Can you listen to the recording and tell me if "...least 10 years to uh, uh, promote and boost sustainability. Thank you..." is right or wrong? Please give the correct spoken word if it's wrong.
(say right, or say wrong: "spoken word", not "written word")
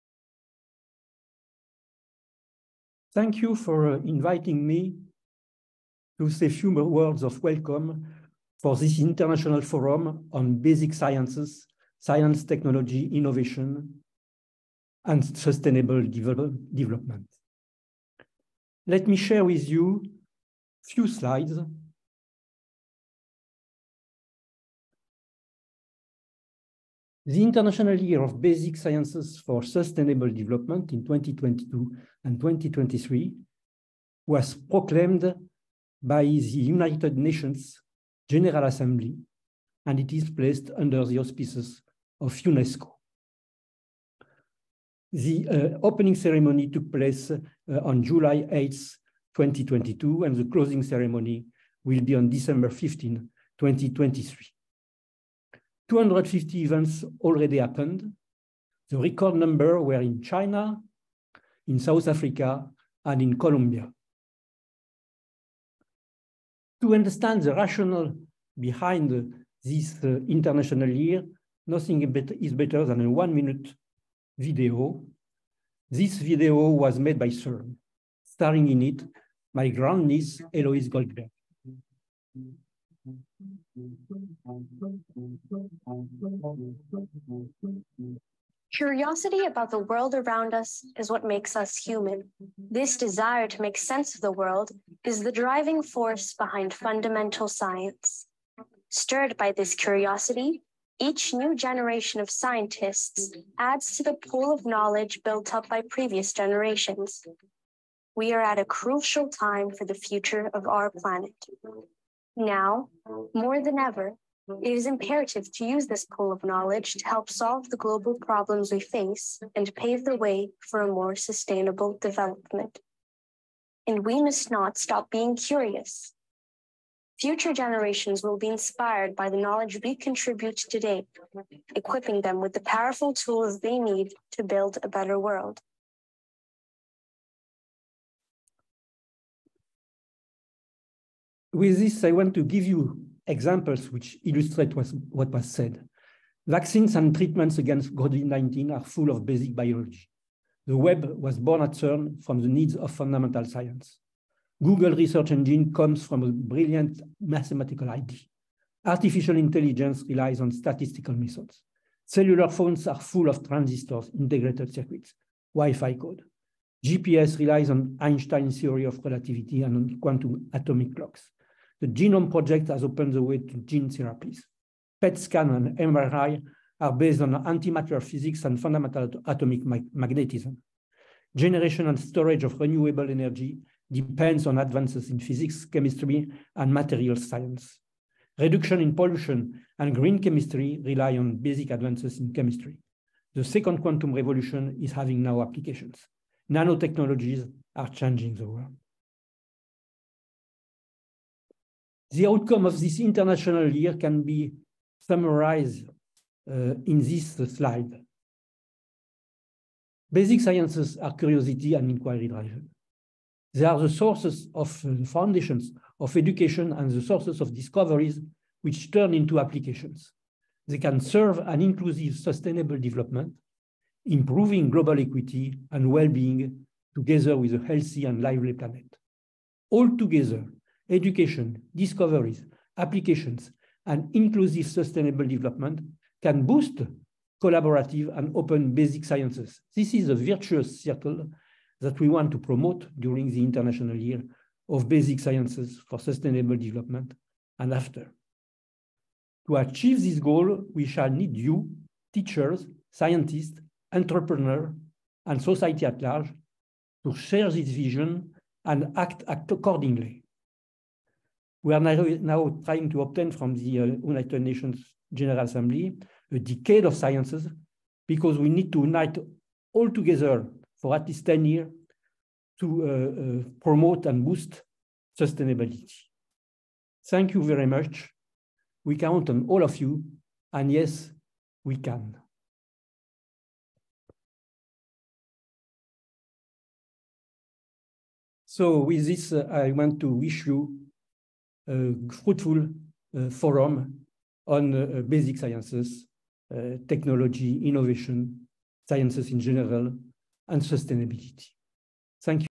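right.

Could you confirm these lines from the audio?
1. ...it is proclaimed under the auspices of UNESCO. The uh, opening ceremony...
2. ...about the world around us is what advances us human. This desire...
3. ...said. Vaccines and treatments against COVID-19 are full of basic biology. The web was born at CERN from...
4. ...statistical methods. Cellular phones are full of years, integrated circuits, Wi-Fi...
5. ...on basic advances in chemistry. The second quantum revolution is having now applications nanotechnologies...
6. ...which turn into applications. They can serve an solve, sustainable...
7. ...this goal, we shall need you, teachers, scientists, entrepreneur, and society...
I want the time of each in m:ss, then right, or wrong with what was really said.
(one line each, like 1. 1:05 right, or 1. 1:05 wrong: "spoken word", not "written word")
1. 0:39 wrong: "placed", not "proclaimed"
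2. 1:29 wrong: "makes", not "advances"
3. 2:25 right
4. 2:40 wrong: "transistors", not "years"
5. 3:11 right
6. 3:38 wrong: "inclusive", not "solve"
7. 4:10 right.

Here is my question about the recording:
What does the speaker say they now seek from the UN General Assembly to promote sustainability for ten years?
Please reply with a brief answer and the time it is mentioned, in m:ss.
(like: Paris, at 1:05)
a decade of sciences, at 4:26.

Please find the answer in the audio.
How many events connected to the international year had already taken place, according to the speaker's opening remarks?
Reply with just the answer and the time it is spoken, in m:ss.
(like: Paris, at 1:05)
250, at 0:55.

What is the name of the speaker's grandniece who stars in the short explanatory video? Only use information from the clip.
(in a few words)
Eloise Goldberg.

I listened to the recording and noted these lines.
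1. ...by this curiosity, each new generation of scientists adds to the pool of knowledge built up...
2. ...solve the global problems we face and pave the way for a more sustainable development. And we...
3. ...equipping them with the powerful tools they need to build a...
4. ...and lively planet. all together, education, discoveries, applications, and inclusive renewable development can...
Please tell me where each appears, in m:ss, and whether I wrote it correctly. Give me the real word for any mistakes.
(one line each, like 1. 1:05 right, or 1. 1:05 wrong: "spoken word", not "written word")
1. 1:39 right
2. 1:57 right
3. 2:11 right
4. 3:48 wrong: "sustainable", not "renewable".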